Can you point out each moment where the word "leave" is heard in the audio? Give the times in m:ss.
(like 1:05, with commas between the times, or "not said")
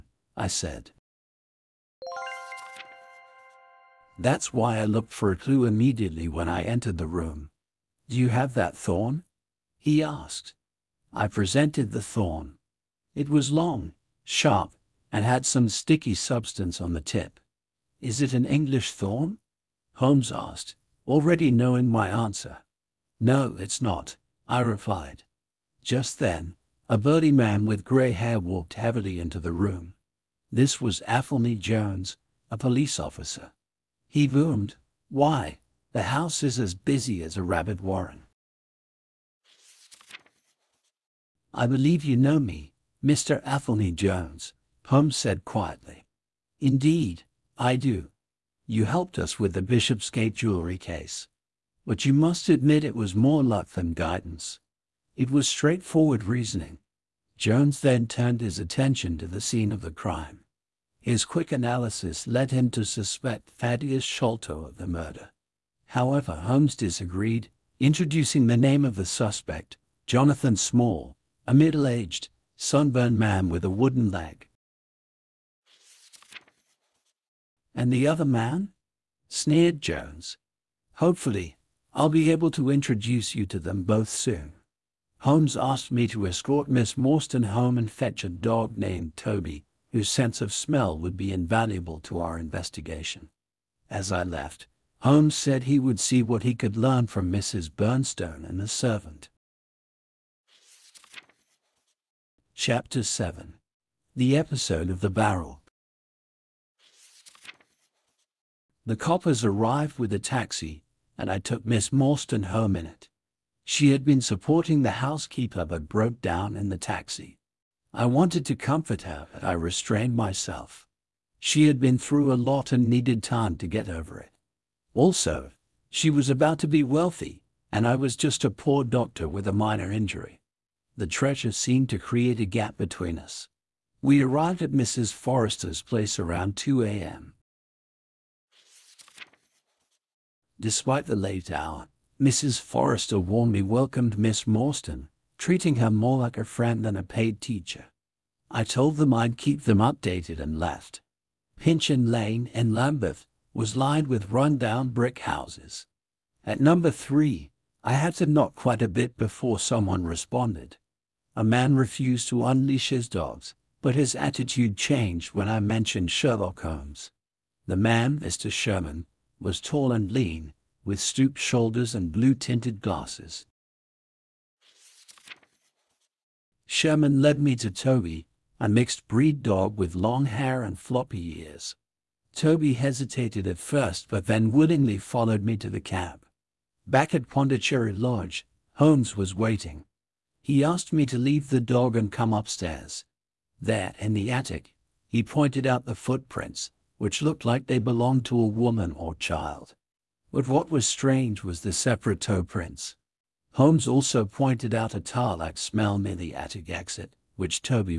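3:11.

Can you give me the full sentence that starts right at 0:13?
It was long, sharp, and had some sticky substance on the tip.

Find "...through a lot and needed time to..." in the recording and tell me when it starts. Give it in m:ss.
2:01.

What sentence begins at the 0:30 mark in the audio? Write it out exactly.
This was Athelney Jones, a police officer.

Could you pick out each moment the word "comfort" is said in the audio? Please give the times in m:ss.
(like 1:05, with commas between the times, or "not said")
1:58.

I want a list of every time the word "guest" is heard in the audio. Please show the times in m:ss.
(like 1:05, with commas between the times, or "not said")
not said.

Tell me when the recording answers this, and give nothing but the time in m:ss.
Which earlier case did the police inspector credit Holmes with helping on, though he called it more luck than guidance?
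0:49.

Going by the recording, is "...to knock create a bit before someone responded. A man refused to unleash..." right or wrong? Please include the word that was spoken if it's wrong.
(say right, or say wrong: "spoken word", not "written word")
wrong: "quite", not "create".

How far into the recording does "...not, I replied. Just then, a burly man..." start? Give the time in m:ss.
0:23.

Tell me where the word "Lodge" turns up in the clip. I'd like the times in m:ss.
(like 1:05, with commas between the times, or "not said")
3:07.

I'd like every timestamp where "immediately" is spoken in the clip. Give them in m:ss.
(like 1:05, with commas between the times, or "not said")
0:05.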